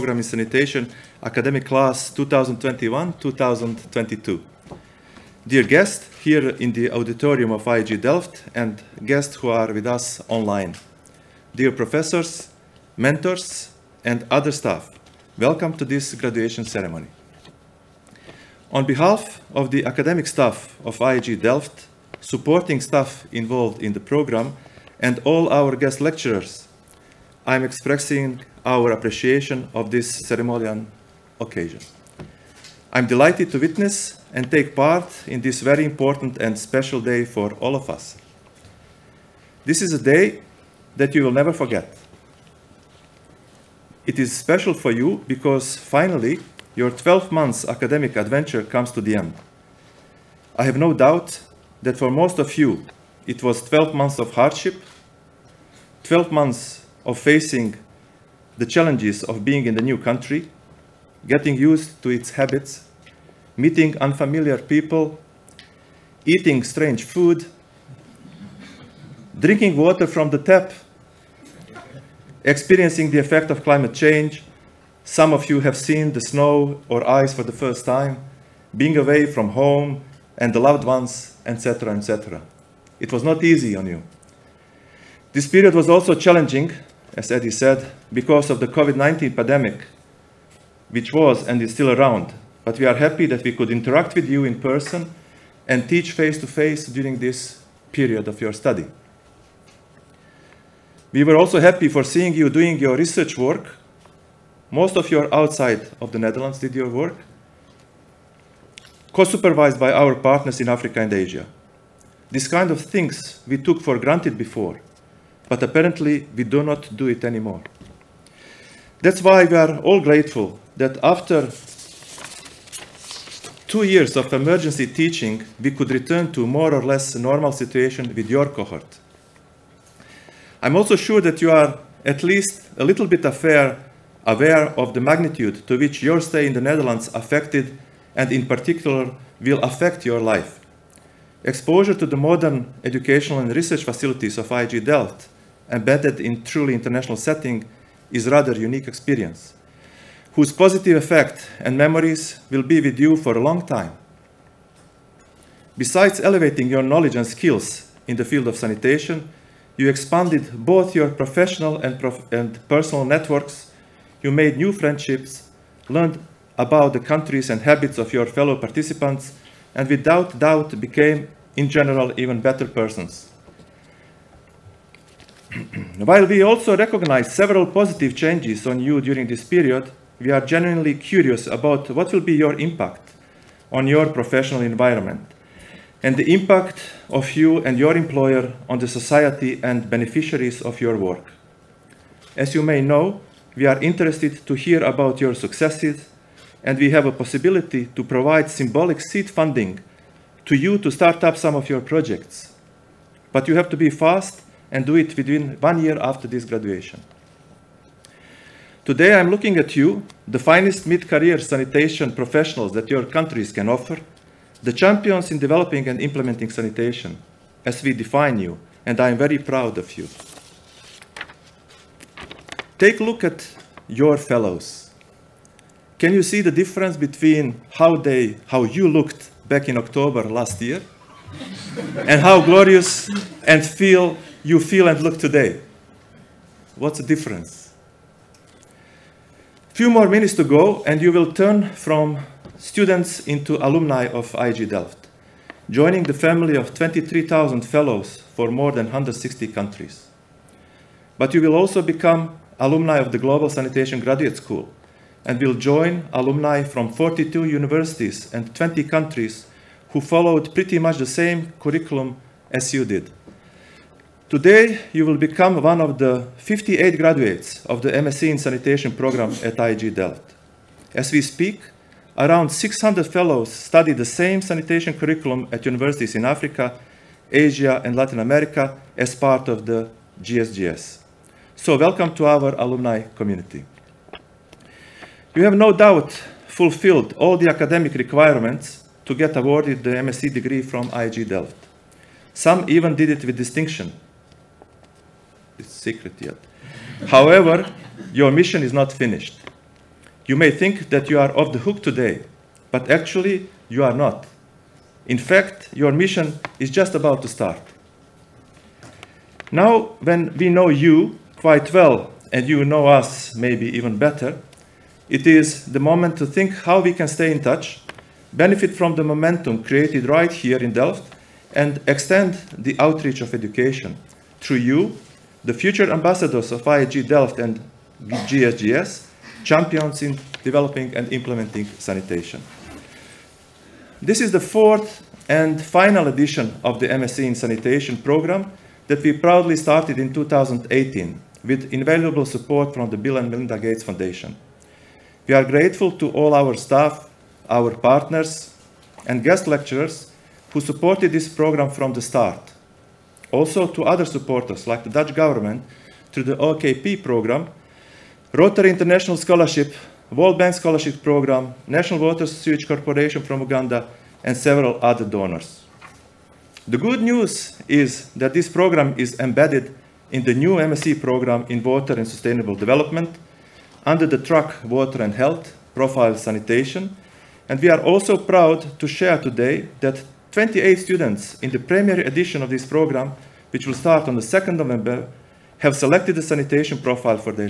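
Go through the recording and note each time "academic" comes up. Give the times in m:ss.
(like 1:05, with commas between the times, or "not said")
0:01, 0:19, 0:47, 4:47.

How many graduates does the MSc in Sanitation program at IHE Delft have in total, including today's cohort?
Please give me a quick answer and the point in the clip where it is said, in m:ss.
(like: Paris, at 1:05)
58, at 4:26.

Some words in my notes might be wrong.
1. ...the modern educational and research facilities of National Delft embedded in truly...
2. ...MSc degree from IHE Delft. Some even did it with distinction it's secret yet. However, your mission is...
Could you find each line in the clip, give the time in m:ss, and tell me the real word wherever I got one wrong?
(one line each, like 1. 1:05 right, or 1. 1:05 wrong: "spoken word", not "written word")
1. 2:22 wrong: "IHE", not "National"
2. 4:49 right.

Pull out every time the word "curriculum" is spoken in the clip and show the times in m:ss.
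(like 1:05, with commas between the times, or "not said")
4:21, 4:34.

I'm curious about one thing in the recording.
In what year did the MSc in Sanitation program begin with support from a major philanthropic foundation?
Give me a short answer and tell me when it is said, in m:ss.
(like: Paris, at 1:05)
2018, at 5:40.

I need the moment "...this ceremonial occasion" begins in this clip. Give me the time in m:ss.
0:29.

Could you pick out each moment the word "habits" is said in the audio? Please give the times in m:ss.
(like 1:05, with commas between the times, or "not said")
1:02, 2:47.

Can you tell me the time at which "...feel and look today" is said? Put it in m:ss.
3:54.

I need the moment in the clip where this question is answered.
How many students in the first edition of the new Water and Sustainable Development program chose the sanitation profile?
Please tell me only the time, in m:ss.
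6:20.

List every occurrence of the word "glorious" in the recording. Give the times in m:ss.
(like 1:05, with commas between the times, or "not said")
3:52.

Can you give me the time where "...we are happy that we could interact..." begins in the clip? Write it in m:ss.
1:32.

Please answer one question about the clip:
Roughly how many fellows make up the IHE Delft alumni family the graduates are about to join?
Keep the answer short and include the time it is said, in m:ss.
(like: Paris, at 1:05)
23,000, at 4:06.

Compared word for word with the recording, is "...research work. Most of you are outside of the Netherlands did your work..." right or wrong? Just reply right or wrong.
right.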